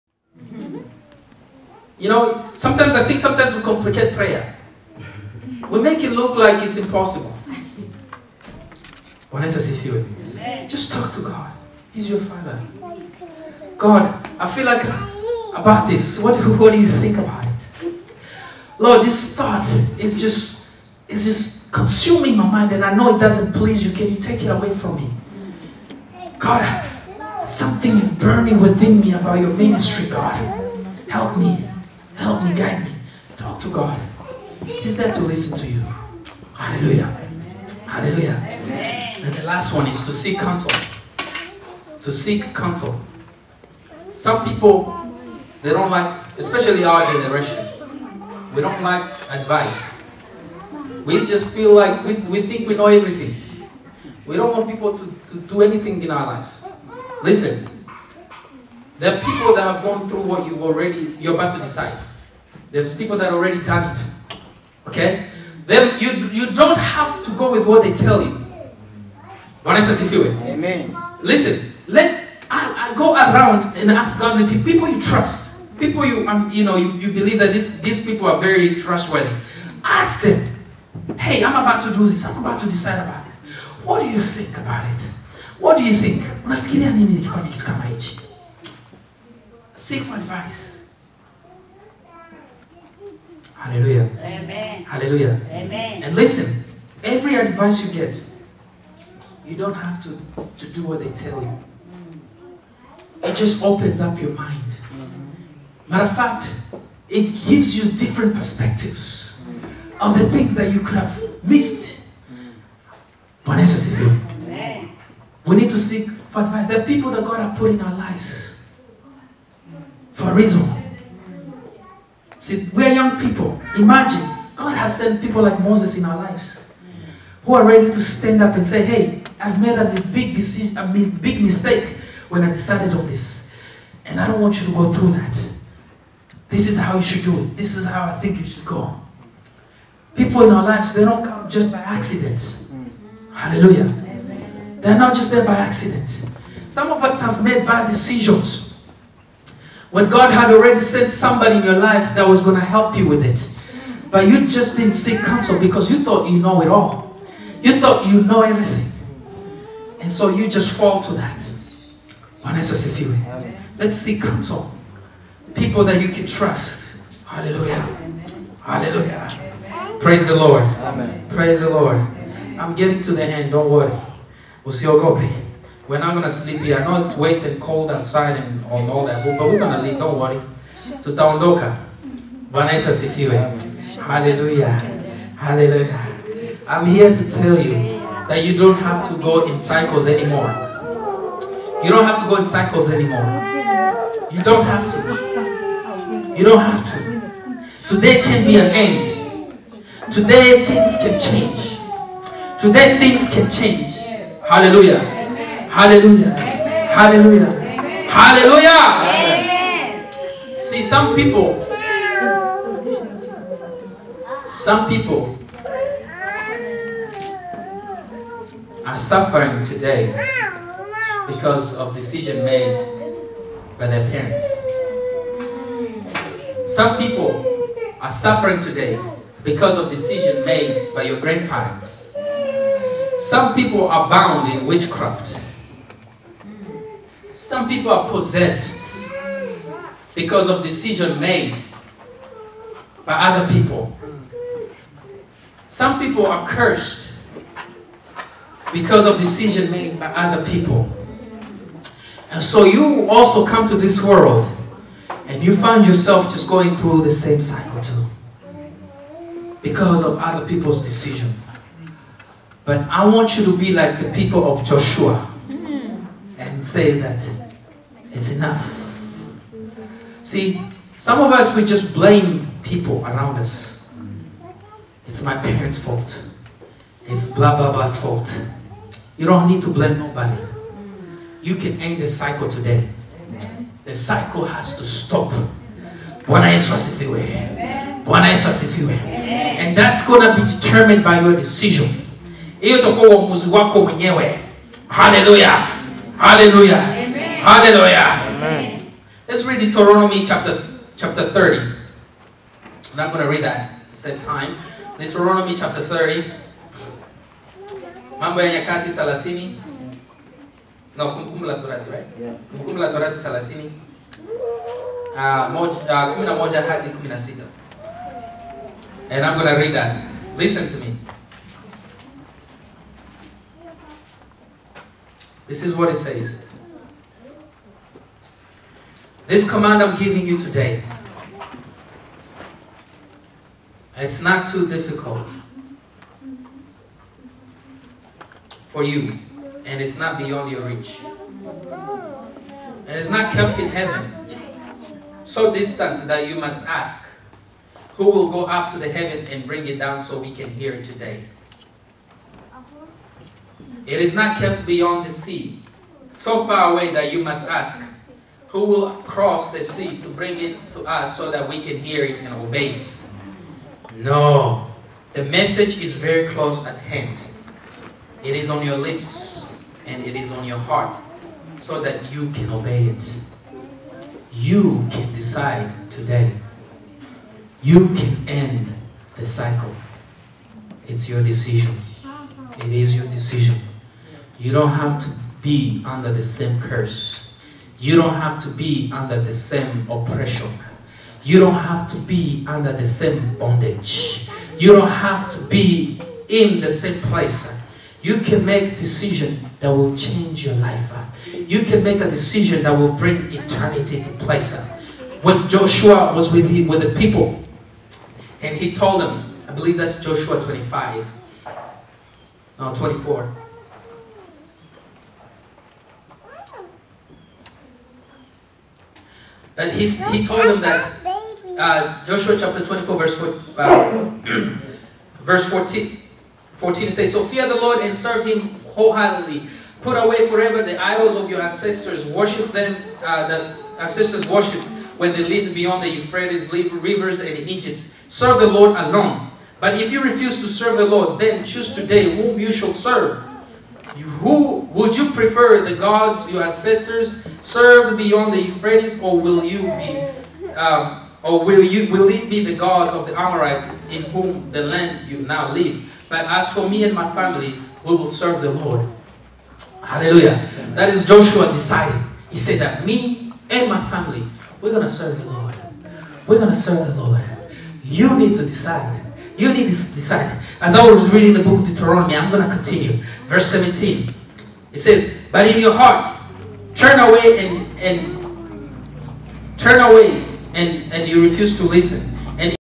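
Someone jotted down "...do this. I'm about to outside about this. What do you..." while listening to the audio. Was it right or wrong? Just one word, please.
wrong.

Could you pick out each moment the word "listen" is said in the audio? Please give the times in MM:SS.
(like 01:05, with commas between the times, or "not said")
00:35, 00:57, 01:11, 01:36, 05:20, 08:01.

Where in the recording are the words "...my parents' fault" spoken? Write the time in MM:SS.
04:35.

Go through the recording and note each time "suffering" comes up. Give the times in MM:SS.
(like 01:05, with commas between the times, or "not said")
03:38, 03:48.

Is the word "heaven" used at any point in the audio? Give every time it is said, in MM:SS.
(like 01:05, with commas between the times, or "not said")
05:43, 05:48.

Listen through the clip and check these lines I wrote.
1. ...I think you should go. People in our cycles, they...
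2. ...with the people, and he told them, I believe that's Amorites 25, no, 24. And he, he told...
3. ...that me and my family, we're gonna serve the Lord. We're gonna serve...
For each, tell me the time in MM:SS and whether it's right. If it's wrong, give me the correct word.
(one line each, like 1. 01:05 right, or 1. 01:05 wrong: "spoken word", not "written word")
1. 02:18 wrong: "lives", not "cycles"
2. 06:46 wrong: "Joshua", not "Amorites"
3. 07:42 right.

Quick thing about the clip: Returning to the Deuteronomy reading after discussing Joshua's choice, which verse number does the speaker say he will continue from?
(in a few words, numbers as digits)
17.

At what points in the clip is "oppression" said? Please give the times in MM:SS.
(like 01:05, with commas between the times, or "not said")
06:29.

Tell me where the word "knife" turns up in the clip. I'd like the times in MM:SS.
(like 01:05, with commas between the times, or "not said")
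not said.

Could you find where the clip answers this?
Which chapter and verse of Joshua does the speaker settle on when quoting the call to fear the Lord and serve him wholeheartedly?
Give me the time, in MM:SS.
07:05.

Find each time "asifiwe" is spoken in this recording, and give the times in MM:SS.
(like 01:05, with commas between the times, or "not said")
01:09, 03:03.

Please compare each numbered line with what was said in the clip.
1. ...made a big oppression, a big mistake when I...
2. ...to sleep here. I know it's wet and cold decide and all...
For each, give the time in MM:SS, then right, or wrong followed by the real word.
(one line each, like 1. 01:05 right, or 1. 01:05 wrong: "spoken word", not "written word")
1. 02:09 wrong: "decision", not "oppression"
2. 02:56 wrong: "outside", not "decide".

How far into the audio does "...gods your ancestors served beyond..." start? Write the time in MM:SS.
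07:25.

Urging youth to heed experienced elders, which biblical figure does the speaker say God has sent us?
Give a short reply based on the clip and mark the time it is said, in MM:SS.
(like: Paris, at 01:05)
Moses, at 02:05.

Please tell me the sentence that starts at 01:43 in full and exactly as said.
It just opens up your mind.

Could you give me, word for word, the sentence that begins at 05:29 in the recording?
This command I'm giving you today.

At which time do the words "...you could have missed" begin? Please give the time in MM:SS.
01:50.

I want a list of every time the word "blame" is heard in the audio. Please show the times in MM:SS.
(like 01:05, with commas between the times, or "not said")
04:31, 04:39.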